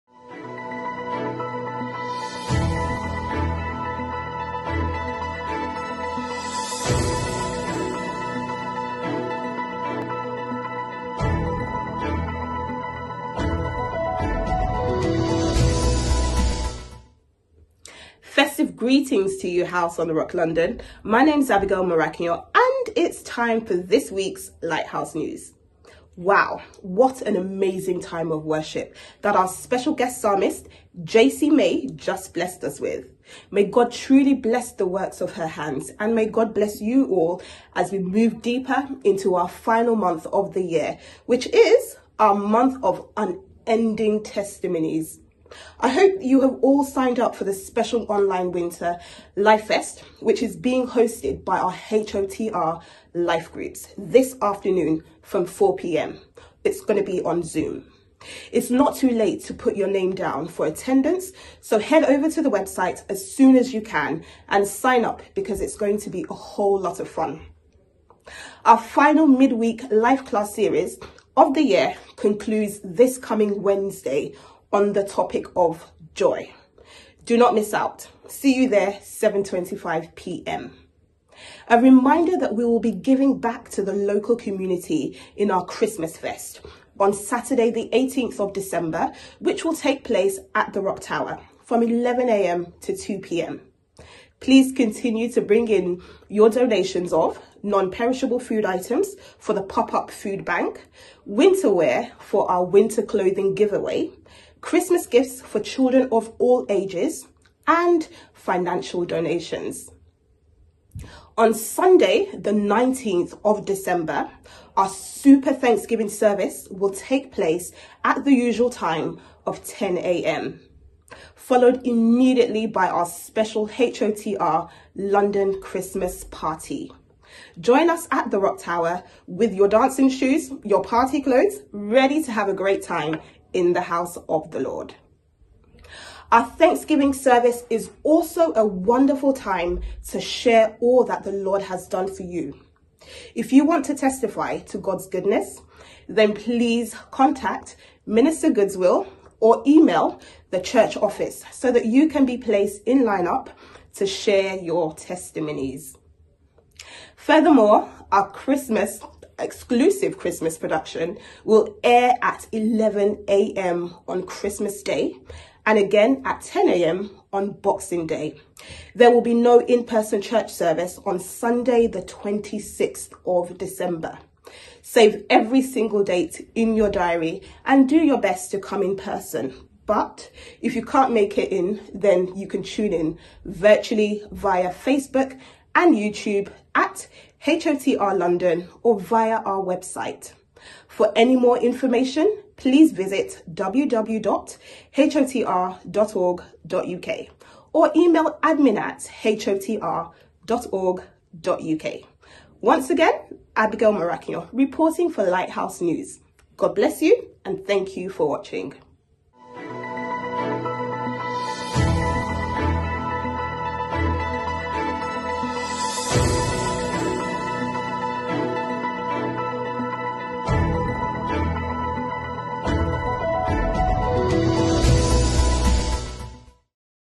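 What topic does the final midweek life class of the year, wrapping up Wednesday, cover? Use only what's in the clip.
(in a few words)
Joy.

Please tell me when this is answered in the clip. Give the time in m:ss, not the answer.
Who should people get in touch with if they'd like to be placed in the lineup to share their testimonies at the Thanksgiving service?
2:28.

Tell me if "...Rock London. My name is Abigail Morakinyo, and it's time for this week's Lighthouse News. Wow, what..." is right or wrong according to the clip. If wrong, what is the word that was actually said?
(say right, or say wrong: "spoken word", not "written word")
right.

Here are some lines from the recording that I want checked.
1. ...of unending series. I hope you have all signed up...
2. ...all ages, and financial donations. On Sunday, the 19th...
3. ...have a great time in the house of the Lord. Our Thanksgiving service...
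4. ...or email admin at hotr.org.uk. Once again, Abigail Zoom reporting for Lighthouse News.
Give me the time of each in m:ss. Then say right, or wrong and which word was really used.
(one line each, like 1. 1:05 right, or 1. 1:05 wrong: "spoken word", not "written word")
1. 0:42 wrong: "testimonies", not "series"
2. 1:46 right
3. 2:12 right
4. 3:17 wrong: "Morakinyo", not "Zoom".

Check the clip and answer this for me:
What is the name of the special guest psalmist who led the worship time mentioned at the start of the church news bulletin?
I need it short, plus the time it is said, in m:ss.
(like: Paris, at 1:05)
JC May, at 0:31.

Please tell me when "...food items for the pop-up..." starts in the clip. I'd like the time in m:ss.
1:38.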